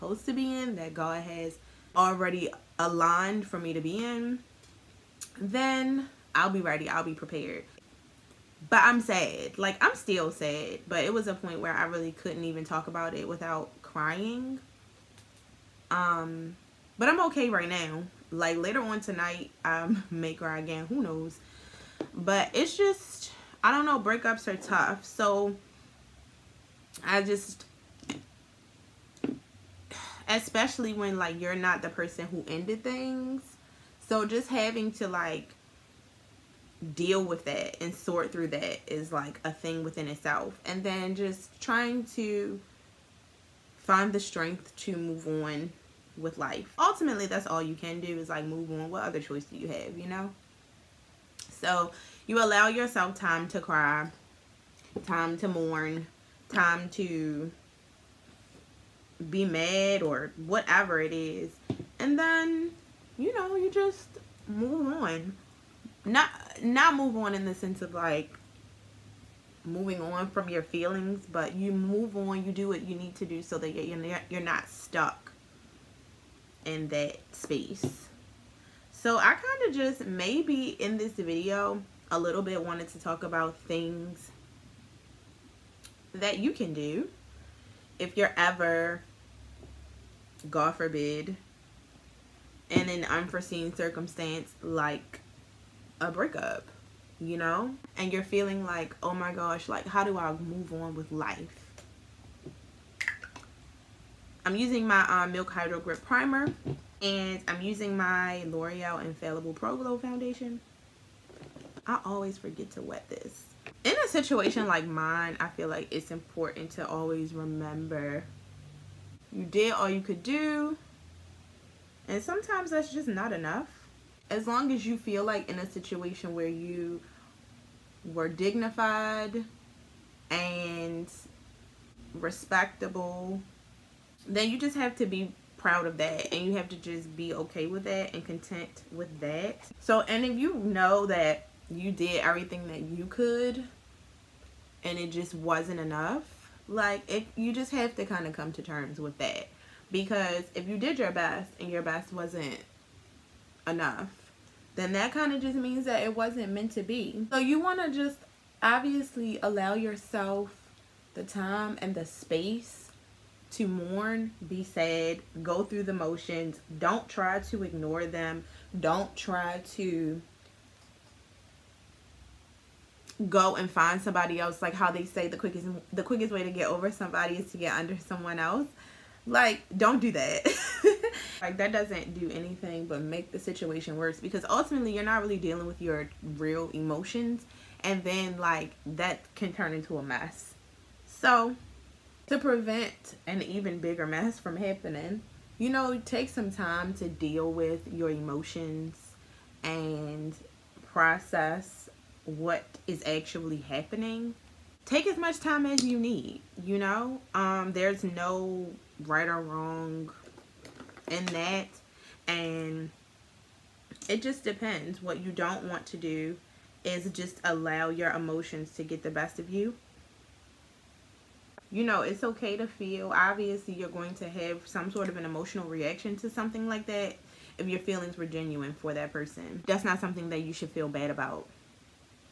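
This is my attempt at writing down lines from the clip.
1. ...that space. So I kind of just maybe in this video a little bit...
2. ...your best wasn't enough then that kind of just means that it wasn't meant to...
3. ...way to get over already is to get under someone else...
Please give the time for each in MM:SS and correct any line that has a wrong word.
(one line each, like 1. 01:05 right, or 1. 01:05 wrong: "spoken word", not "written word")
1. 01:16 right
2. 02:31 right
3. 02:56 wrong: "somebody", not "already".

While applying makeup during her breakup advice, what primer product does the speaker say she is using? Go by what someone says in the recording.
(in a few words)
Milk Hydro Grip Primer.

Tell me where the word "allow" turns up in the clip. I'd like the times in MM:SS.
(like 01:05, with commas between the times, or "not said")
00:52, 02:39, 03:37.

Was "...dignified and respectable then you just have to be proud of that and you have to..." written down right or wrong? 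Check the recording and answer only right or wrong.
right.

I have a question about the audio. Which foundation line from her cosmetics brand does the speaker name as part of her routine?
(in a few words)
Infallible Pro Glow.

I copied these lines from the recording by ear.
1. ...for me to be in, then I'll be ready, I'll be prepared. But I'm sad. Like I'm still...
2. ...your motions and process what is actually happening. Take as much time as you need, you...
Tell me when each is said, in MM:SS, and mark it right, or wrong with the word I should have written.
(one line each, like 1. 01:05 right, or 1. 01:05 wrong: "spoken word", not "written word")
1. 00:03 right
2. 03:17 wrong: "emotions", not "motions".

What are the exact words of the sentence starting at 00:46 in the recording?
Ultimately, that's all you can do is like move on.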